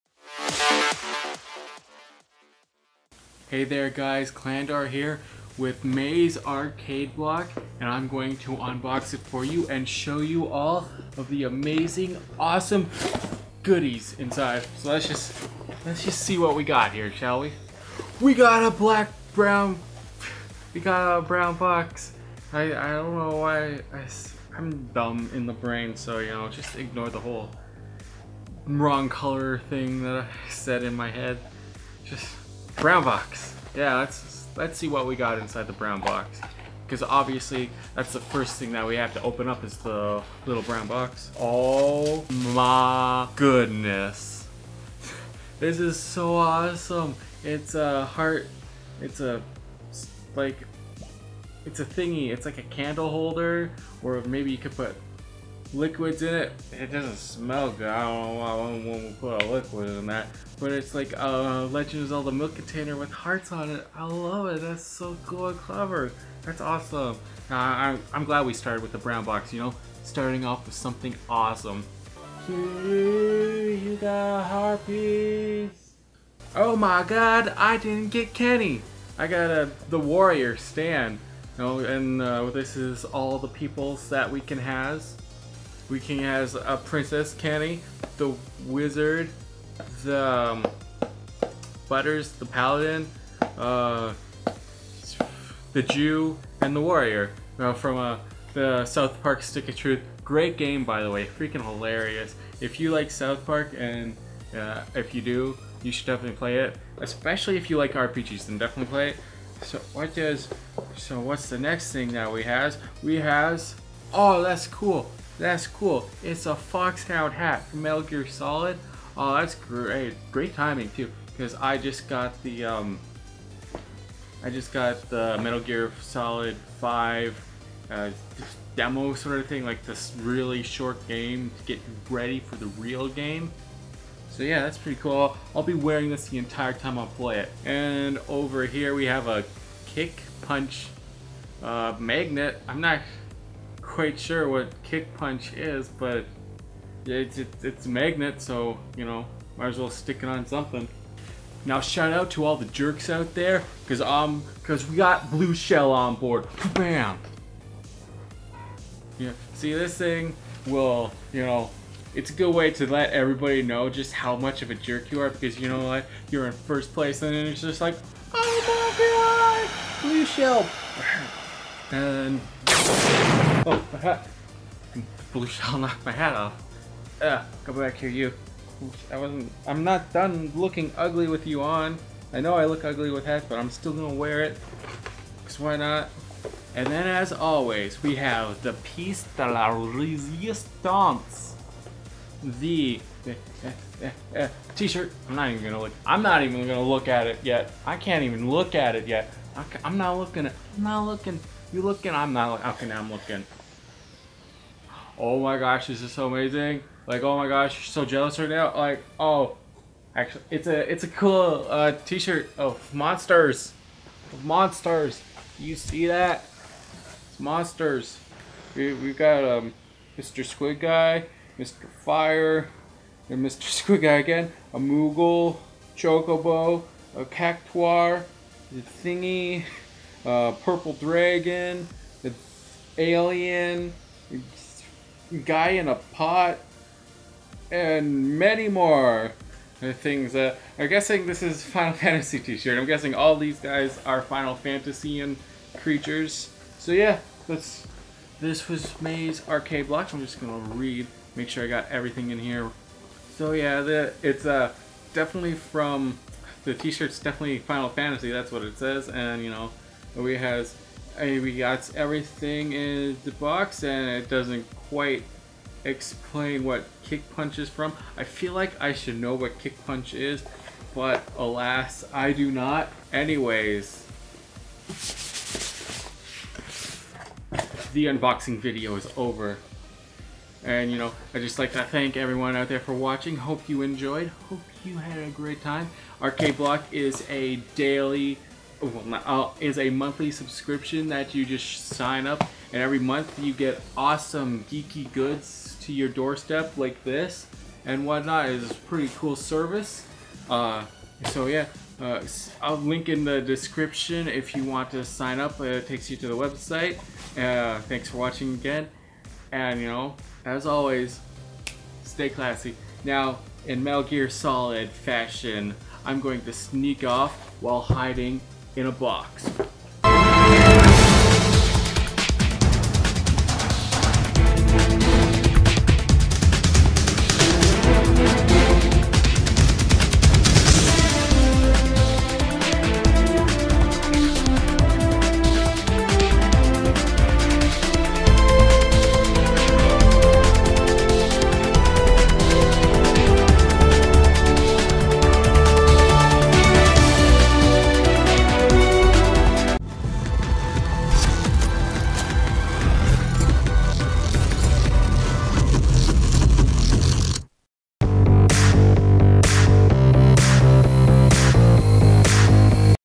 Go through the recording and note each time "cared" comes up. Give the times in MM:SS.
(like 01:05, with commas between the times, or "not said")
not said.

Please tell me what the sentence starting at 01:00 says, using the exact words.
But it's like a uh, Legend of Zelda milk container with hearts on it.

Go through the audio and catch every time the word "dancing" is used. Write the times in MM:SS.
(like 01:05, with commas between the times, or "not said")
not said.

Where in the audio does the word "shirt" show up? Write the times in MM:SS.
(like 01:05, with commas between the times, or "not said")
03:14, 03:32, 04:02, 04:16.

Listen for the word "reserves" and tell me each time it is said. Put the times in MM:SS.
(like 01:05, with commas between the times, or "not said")
not said.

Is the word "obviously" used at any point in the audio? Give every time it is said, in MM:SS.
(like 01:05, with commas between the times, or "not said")
00:37.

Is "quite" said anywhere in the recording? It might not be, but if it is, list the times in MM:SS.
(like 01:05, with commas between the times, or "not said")
02:23, 04:24.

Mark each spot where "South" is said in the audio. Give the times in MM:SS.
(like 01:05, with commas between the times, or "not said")
01:38, 01:43.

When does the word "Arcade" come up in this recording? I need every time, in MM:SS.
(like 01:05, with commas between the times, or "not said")
00:06, 04:09, 04:46.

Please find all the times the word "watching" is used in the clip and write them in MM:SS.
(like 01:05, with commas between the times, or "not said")
04:42, 05:08.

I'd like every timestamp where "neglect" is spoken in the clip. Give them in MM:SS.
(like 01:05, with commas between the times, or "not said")
not said.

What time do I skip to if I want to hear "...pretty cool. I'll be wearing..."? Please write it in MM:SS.
02:14.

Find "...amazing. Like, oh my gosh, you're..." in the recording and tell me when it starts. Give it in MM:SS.
03:26.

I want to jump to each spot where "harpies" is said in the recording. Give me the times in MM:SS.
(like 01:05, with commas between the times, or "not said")
01:14.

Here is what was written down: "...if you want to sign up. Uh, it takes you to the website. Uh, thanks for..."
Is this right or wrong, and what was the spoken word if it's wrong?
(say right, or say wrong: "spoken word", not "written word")
right.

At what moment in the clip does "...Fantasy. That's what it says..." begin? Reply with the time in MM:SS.
04:17.